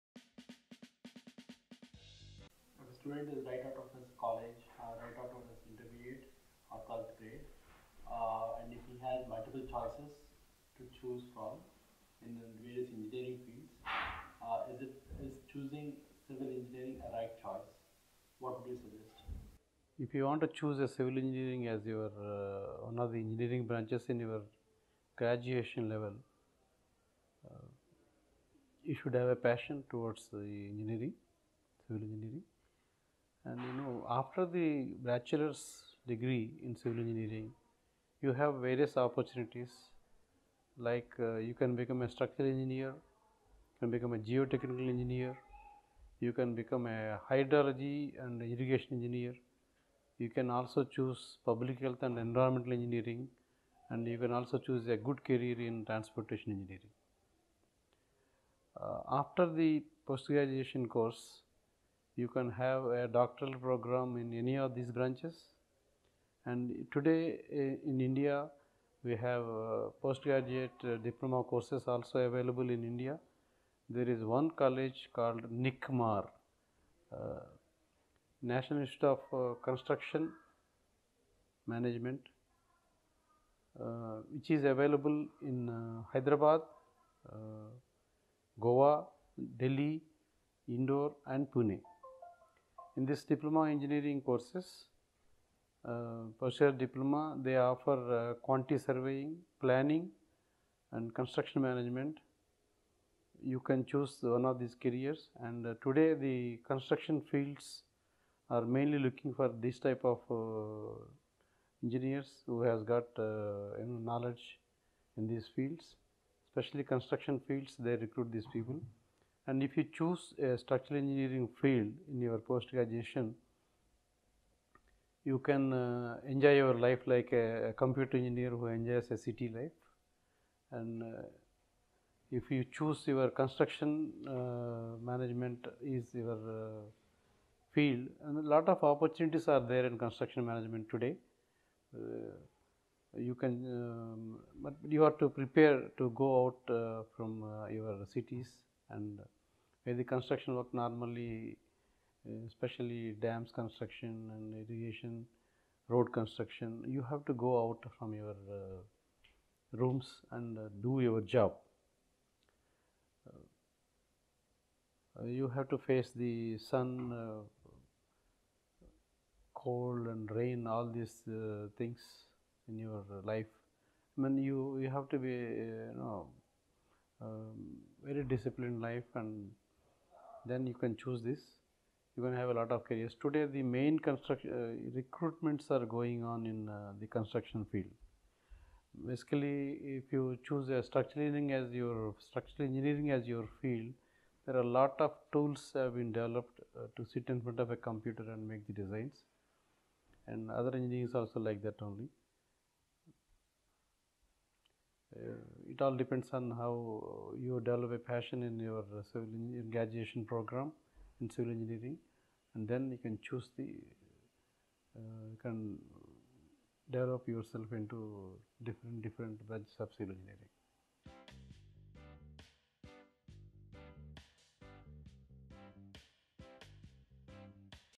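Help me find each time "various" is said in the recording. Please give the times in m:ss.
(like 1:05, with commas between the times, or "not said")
0:12, 0:38.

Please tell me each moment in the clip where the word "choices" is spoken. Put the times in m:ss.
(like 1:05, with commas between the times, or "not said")
0:09, 0:17.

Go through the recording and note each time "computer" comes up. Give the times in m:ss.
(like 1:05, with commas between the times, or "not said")
2:07, 3:17.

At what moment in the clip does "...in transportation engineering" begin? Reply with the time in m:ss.
0:55.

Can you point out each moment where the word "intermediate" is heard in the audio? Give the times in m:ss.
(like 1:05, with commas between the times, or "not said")
0:05.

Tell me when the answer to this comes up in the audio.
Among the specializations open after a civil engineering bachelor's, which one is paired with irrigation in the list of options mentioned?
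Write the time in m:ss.
0:47.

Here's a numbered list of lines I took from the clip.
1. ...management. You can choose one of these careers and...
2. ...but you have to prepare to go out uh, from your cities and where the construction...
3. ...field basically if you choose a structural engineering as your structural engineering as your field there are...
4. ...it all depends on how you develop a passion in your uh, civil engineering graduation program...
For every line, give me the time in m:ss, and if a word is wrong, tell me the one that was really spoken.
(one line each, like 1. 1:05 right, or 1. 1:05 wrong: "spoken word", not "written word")
1. 1:41 right
2. 2:24 right
3. 3:07 right
4. 3:25 right.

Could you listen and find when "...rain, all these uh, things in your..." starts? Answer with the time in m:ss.
2:50.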